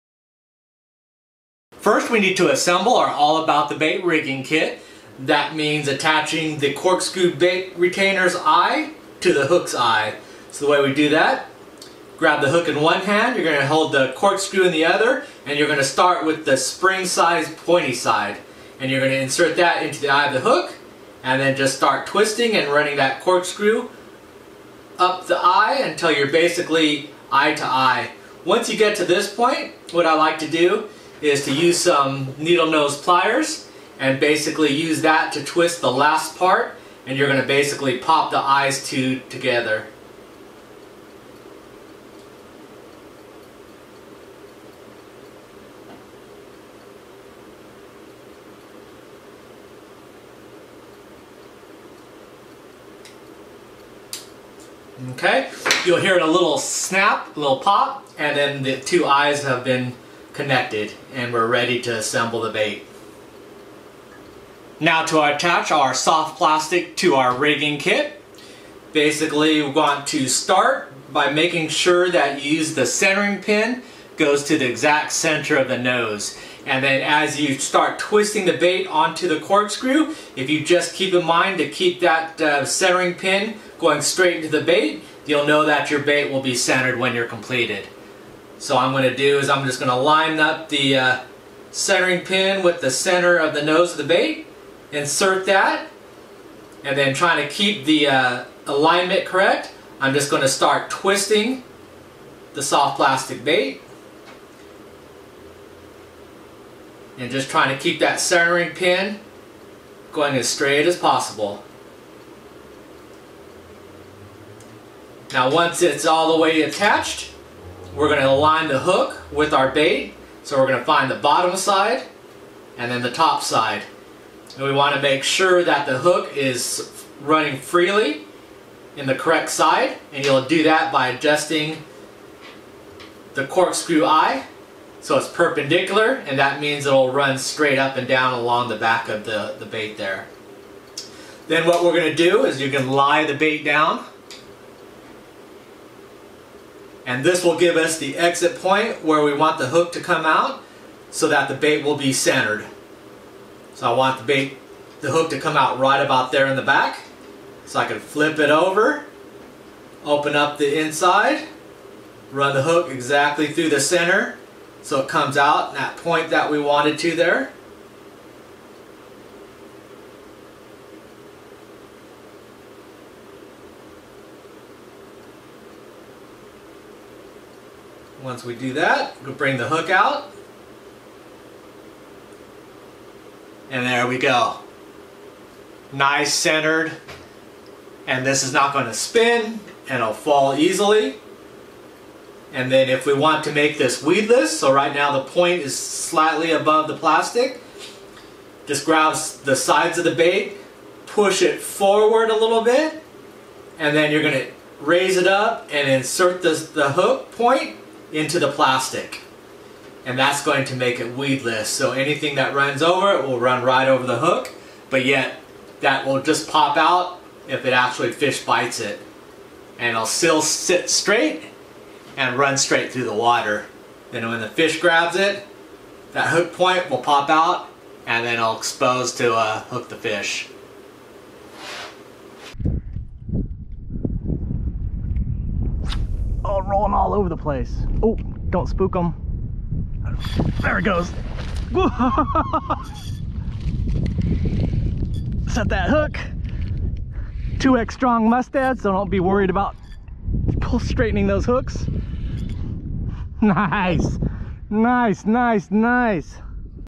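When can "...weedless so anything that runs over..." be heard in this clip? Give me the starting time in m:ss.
3:31.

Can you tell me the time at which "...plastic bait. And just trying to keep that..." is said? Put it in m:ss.
1:42.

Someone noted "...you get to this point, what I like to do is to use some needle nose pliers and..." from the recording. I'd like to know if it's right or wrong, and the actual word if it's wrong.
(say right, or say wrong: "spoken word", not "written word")
right.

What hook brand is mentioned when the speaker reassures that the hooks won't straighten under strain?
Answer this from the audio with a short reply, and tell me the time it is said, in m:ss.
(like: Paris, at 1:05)
Mustad, at 4:08.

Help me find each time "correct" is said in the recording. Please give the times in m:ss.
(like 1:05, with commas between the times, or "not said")
1:39, 2:09.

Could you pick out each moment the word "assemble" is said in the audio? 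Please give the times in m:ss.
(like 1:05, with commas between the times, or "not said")
0:02, 1:01.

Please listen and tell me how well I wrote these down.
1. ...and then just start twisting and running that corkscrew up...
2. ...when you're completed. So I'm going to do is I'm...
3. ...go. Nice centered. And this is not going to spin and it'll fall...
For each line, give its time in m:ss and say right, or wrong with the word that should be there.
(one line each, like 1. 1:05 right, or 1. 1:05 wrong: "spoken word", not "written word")
1. 0:21 right
2. 1:26 right
3. 3:04 right.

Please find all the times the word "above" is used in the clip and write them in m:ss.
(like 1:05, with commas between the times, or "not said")
3:16.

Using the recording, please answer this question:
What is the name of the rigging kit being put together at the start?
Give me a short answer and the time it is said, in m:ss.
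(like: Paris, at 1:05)
All About the Bait, at 0:03.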